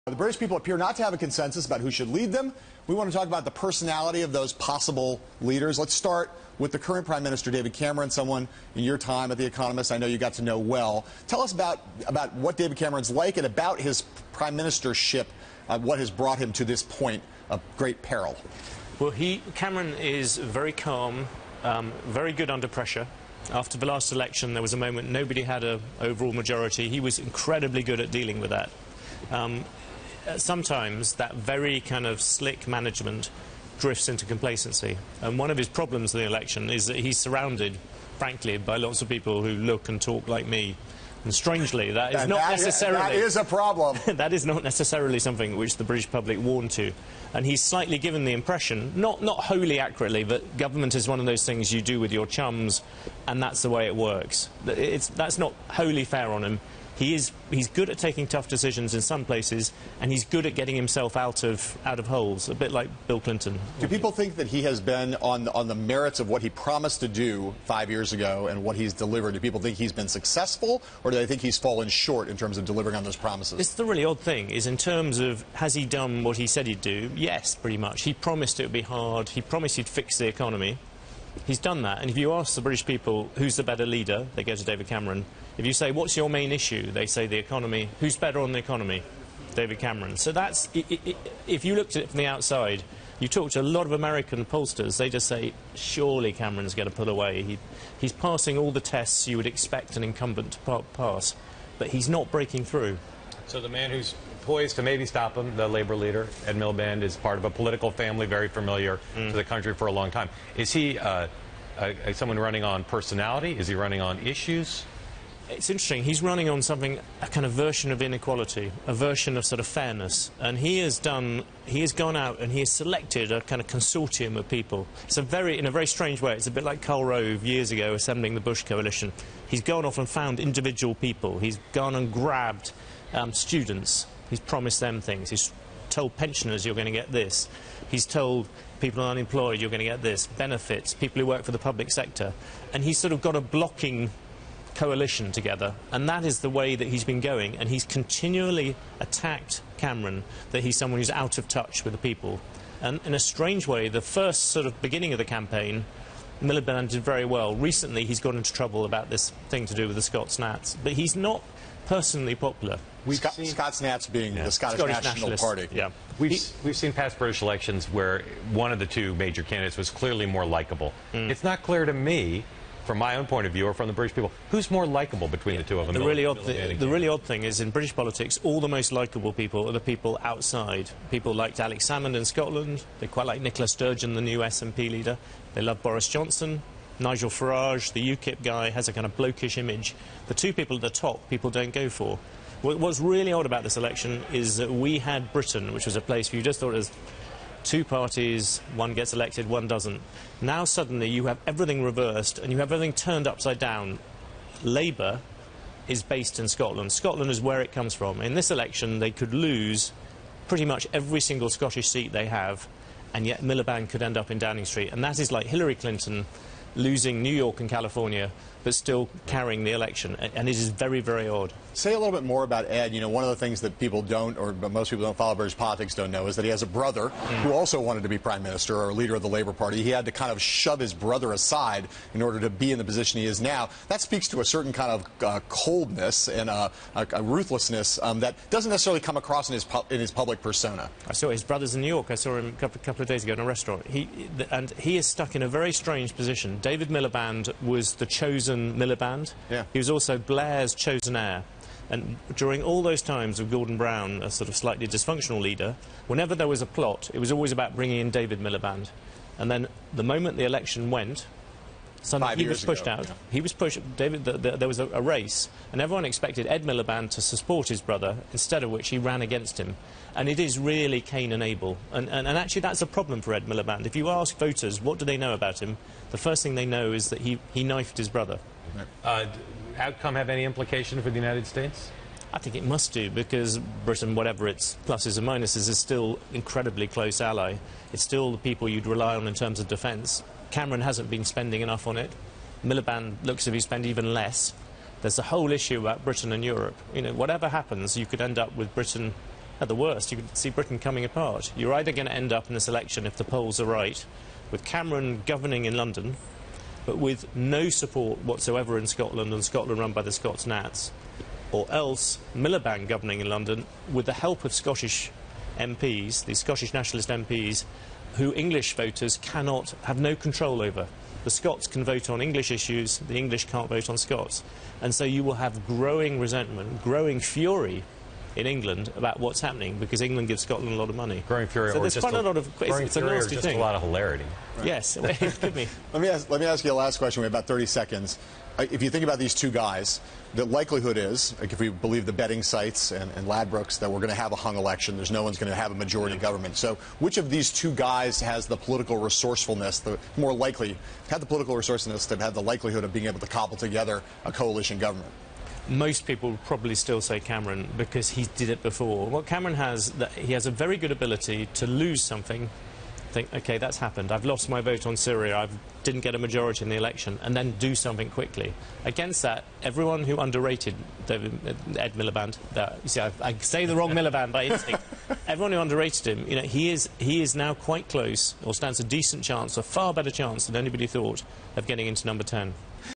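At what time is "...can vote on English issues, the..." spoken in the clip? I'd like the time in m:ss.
5:21.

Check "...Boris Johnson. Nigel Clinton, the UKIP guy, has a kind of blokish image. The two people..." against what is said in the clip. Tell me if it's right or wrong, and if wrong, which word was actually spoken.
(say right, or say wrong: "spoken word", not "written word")
wrong: "Farage", not "Clinton".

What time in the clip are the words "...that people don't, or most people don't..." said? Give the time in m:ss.
3:43.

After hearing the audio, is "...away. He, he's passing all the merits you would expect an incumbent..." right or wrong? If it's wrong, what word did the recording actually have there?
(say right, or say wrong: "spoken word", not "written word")
wrong: "tests", not "merits".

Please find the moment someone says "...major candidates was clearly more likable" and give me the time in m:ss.
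2:49.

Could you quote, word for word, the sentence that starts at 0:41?
And strangely, that is and not that necessarily...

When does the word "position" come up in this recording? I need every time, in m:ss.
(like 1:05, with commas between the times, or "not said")
3:52, 4:06.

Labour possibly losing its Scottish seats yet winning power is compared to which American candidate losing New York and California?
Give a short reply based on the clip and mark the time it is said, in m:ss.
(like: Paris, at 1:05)
Hillary Clinton, at 3:35.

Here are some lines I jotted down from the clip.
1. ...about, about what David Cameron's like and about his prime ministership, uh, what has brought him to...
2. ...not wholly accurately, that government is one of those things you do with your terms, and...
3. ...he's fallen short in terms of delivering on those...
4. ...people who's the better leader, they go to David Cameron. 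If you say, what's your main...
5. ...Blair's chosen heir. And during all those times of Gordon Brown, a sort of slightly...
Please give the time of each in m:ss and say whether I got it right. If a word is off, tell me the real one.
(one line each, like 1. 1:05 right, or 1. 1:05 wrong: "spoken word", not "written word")
1. 0:11 right
2. 0:49 wrong: "chums", not "terms"
3. 1:11 right
4. 1:22 right
5. 4:10 right.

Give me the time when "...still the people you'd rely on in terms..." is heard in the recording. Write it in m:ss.
4:48.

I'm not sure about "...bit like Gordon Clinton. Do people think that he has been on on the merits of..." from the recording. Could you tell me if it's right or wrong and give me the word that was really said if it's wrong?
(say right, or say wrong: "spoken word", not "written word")
wrong: "Bill", not "Gordon".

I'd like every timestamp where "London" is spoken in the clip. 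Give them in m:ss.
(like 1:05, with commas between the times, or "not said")
5:05, 5:13.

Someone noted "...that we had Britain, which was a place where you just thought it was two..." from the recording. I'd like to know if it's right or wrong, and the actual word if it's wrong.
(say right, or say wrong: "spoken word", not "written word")
right.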